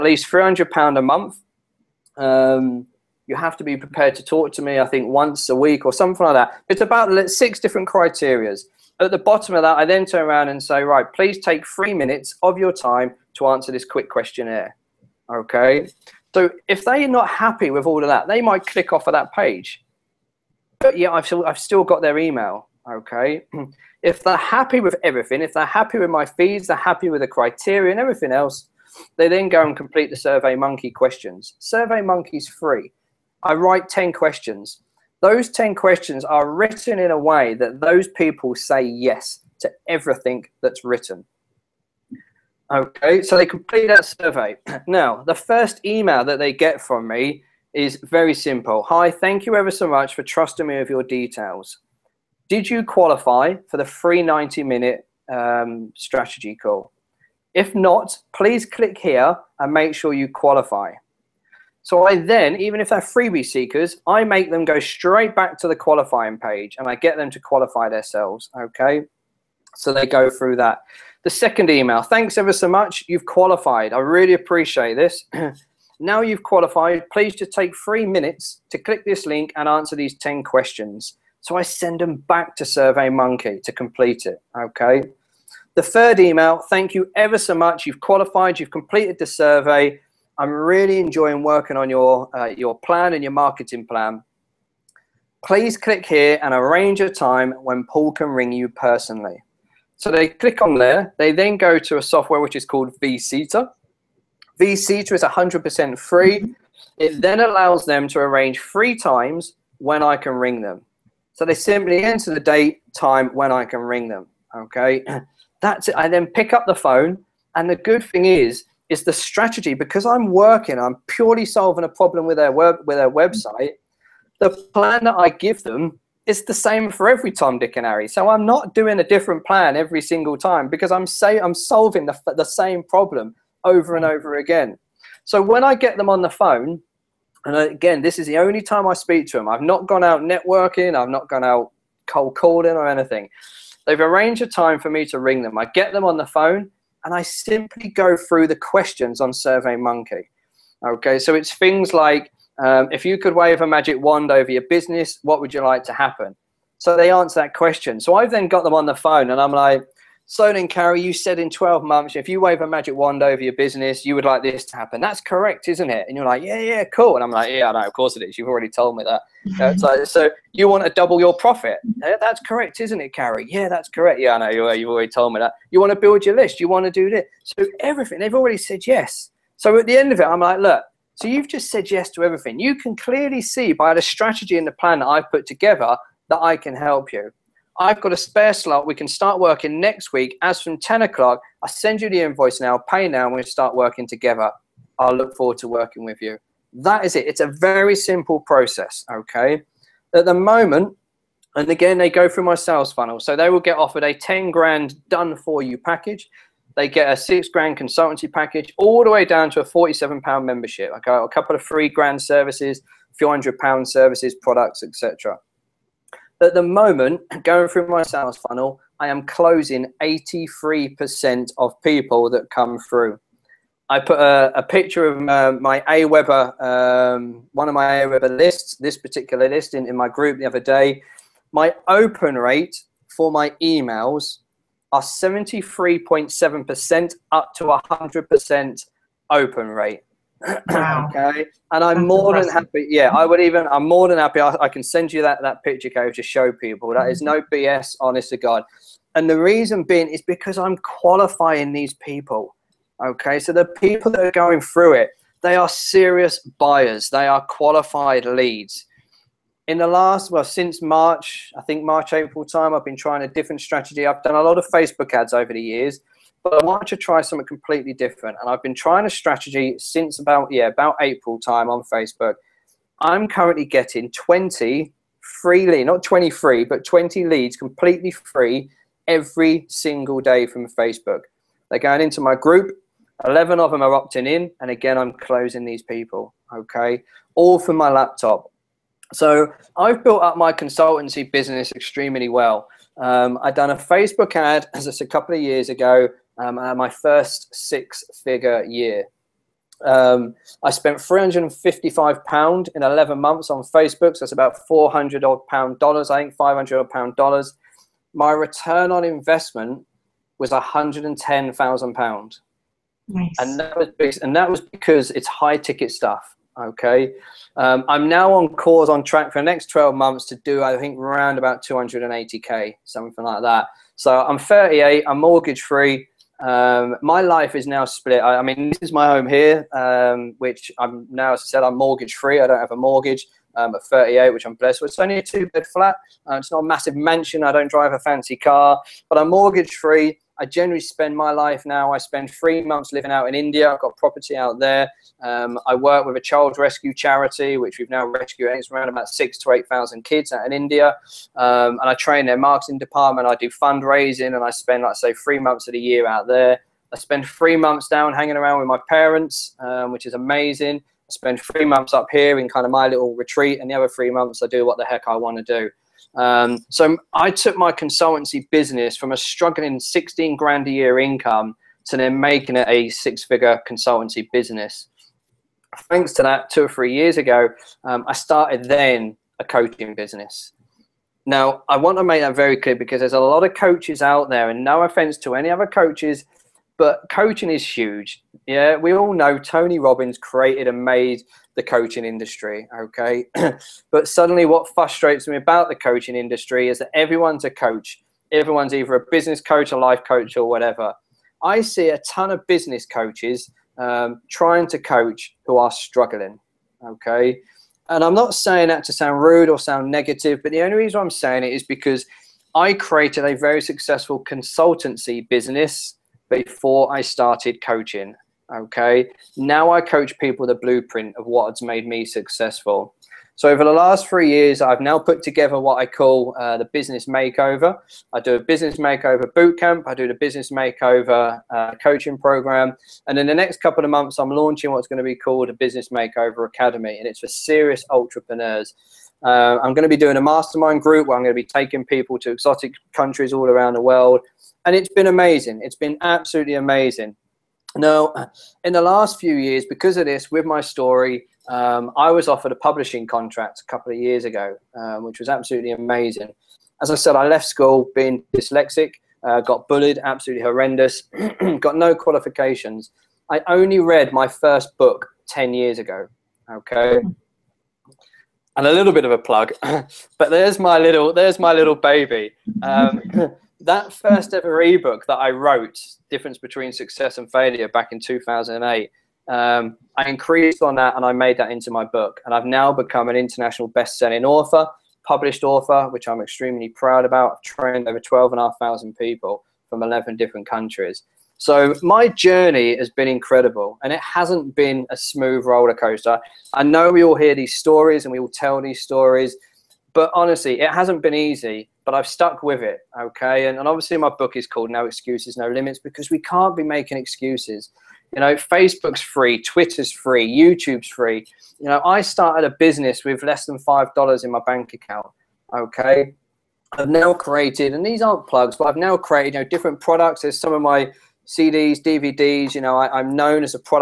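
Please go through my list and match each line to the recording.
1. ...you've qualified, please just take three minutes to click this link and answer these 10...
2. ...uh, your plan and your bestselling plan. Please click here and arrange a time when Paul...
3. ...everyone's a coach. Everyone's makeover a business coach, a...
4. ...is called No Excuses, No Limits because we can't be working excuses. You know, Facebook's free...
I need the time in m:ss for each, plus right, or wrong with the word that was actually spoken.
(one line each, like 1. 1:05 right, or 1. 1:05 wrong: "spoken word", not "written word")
1. 1:16 right
2. 1:32 wrong: "marketing", not "bestselling"
3. 6:36 wrong: "either", not "makeover"
4. 8:24 wrong: "making", not "working".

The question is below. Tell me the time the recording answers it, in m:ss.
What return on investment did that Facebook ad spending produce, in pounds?
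5:10.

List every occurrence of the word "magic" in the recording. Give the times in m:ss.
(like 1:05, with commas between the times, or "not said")
2:33, 2:42.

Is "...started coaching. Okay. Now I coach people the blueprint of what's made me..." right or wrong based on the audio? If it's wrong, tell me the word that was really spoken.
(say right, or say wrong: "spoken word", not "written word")
right.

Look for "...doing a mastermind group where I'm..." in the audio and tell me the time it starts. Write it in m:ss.
7:19.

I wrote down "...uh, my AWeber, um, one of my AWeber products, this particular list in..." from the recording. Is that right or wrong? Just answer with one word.
wrong.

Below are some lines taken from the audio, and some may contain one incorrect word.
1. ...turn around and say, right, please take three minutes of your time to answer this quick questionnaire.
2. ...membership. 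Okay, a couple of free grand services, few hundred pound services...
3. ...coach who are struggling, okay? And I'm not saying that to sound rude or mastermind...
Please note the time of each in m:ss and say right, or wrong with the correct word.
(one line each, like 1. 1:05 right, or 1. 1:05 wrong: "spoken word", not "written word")
1. 0:10 right
2. 3:30 right
3. 6:44 wrong: "sound", not "mastermind".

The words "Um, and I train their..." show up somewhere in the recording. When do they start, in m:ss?
5:51.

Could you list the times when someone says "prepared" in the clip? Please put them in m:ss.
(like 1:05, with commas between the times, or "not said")
0:03.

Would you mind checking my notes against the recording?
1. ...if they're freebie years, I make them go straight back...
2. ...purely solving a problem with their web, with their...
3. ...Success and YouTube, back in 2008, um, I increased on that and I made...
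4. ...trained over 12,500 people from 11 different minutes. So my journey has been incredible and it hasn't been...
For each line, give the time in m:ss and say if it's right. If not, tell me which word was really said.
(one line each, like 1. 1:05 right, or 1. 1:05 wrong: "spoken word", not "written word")
1. 1:02 wrong: "seekers", not "years"
2. 2:01 right
3. 7:56 wrong: "Failure", not "YouTube"
4. 8:07 wrong: "countries", not "minutes".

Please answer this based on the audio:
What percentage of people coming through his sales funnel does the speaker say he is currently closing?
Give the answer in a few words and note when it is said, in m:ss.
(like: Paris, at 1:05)
83%, at 3:40.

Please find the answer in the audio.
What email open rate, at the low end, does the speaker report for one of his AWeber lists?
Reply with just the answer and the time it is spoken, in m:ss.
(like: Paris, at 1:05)
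73.7%, at 3:55.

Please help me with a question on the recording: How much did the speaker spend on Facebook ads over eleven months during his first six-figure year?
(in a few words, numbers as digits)
£355.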